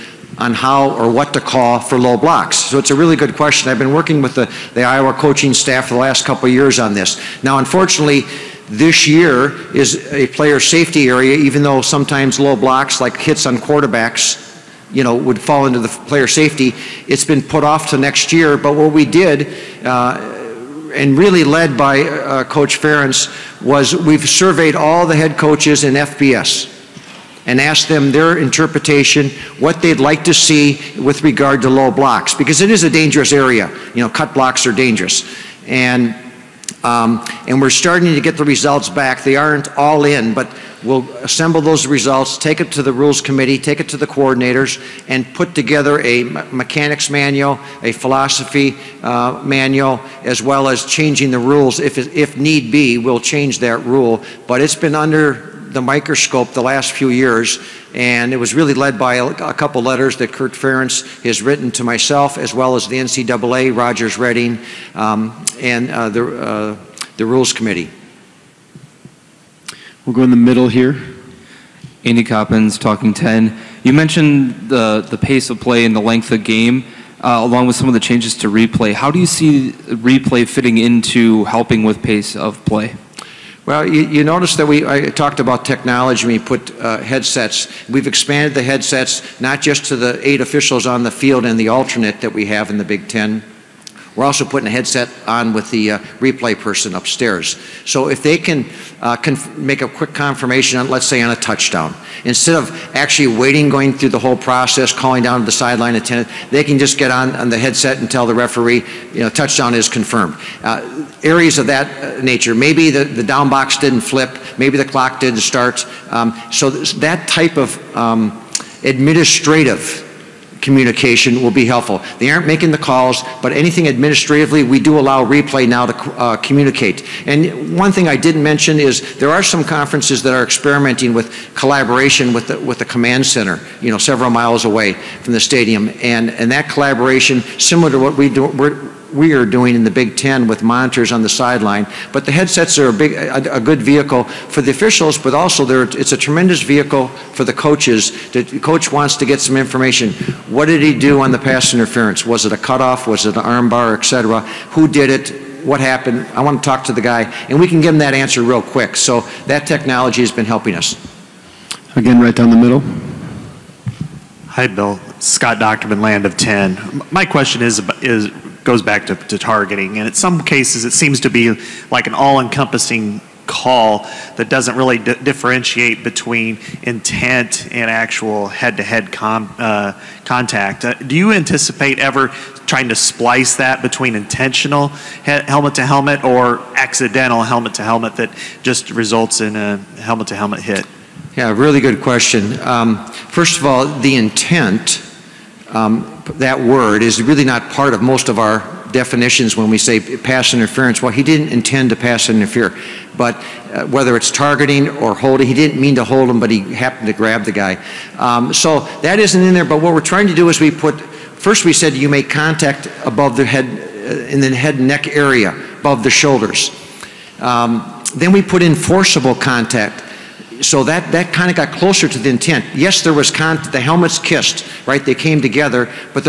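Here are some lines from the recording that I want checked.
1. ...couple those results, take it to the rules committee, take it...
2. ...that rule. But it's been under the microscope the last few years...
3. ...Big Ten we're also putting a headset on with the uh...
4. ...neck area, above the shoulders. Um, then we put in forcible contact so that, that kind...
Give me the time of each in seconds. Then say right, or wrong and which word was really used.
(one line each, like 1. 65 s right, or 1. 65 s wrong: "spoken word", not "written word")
1. 41 s wrong: "assemble", not "couple"
2. 53 s right
3. 92 s right
4. 214 s right.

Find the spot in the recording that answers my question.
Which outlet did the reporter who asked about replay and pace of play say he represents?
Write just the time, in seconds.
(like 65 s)
72 s.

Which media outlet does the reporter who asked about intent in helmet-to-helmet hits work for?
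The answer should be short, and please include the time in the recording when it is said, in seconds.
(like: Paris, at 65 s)
Land of 10, at 166 s.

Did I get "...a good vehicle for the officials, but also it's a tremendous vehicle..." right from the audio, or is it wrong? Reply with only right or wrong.
right.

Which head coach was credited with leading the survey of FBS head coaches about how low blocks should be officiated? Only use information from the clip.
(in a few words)
Kirk Ferentz.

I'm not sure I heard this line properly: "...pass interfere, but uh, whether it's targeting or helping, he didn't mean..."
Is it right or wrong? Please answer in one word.
wrong.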